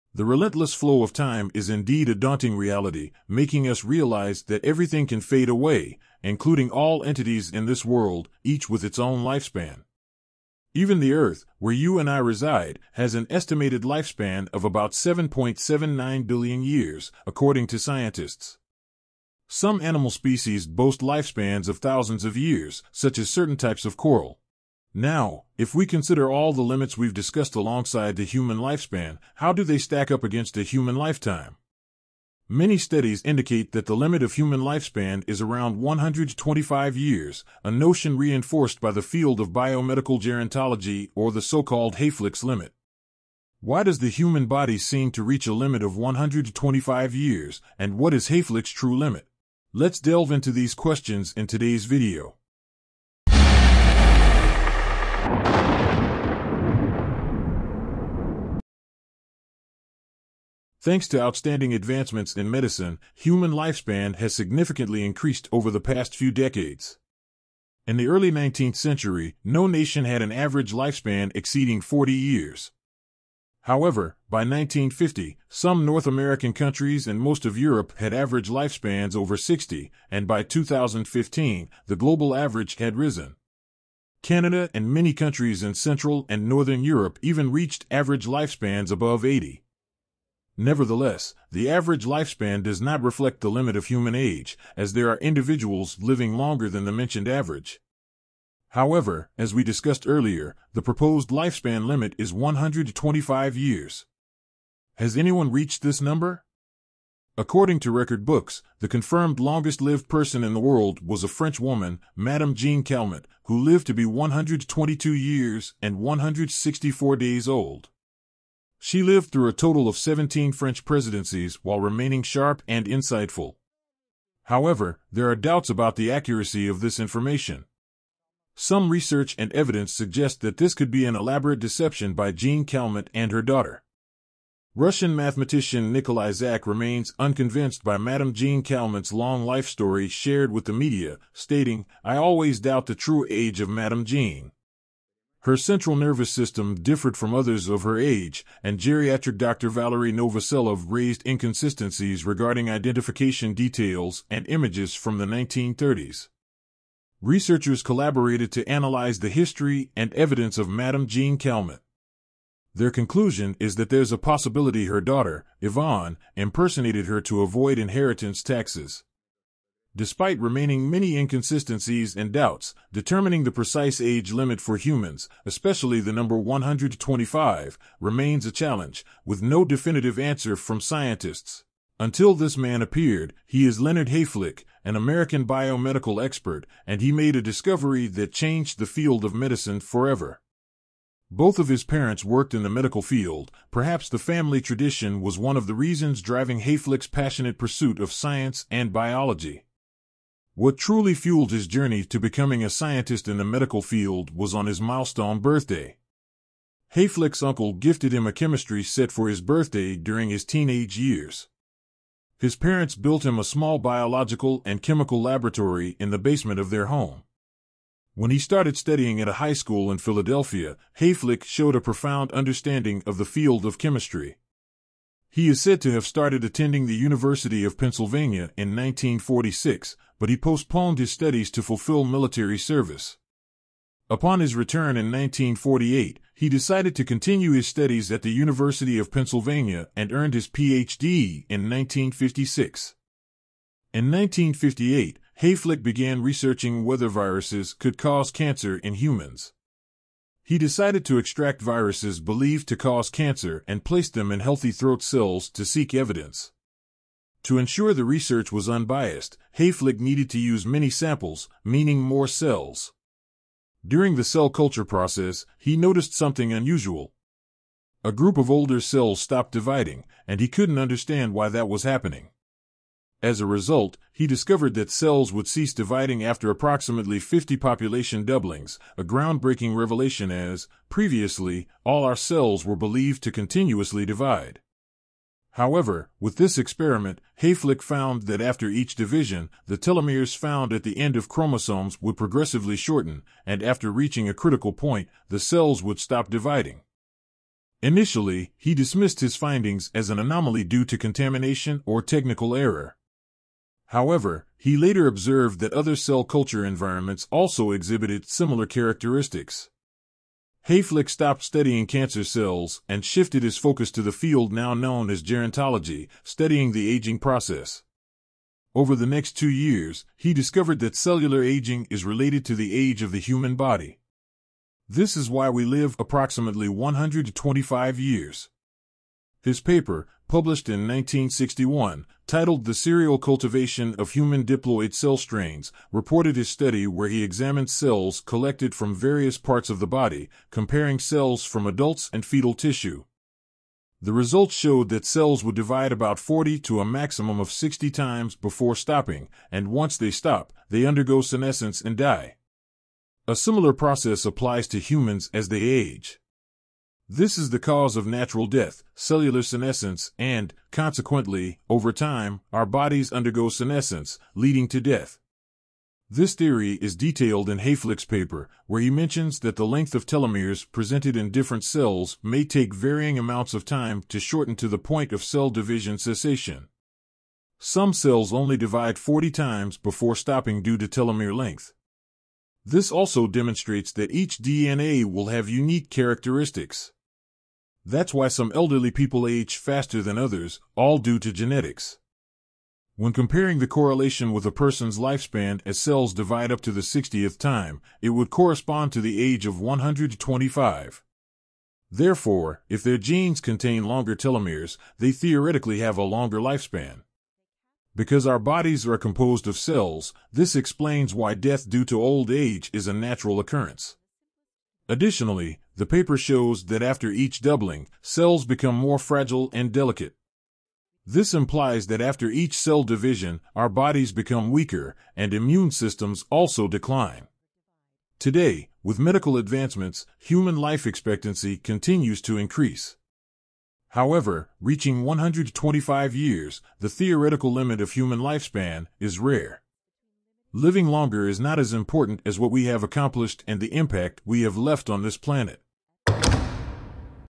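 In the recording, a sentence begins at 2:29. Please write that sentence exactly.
Valerie Novoselov raised inconsistencies regarding identification details and images from the 1930s.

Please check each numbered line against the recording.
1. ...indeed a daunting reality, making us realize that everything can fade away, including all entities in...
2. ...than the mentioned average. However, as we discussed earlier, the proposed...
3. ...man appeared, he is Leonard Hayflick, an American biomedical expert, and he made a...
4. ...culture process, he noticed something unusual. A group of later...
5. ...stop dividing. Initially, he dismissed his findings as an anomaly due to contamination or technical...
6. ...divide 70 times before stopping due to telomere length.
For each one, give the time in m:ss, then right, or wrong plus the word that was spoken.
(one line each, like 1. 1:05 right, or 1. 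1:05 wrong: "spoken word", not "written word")
1. 0:01 right
2. 1:36 right
3. 3:02 right
4. 4:24 wrong: "older", not "later"
5. 4:55 right
6. 6:18 wrong: "40", not "70".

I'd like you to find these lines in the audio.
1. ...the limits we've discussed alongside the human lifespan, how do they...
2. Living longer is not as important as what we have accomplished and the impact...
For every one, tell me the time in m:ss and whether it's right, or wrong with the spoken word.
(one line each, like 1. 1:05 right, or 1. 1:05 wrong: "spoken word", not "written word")
1. 0:26 right
2. 7:20 right.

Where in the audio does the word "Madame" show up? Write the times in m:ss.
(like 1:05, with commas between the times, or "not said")
1:52, 2:17, 2:23, 2:40.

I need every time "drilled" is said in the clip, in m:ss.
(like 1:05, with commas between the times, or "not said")
not said.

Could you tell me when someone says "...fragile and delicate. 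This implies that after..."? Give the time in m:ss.
6:58.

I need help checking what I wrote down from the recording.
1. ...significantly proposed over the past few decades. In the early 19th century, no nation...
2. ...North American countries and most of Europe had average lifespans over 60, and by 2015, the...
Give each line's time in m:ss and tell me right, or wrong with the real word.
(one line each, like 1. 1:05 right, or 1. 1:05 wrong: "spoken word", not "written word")
1. 1:04 wrong: "increased", not "proposed"
2. 1:15 right.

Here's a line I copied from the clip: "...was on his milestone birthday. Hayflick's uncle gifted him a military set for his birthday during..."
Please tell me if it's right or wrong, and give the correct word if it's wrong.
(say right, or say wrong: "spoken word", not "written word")
wrong: "chemistry", not "military".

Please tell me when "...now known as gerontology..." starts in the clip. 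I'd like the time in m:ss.
5:14.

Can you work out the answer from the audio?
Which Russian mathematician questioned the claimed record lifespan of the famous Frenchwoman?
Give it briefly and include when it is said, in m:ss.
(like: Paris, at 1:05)
Nikolai Zak, at 2:15.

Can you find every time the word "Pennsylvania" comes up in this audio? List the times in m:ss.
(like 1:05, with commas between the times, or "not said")
3:47, 3:59.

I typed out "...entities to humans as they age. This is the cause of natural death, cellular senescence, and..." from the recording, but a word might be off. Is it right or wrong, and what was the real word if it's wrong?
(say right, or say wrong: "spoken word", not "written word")
wrong: "applies", not "entities".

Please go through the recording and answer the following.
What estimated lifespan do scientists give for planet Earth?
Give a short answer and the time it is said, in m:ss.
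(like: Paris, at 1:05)
7.79 billion years, at 0:14.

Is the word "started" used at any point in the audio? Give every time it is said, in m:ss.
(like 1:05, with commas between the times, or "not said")
3:38, 3:46.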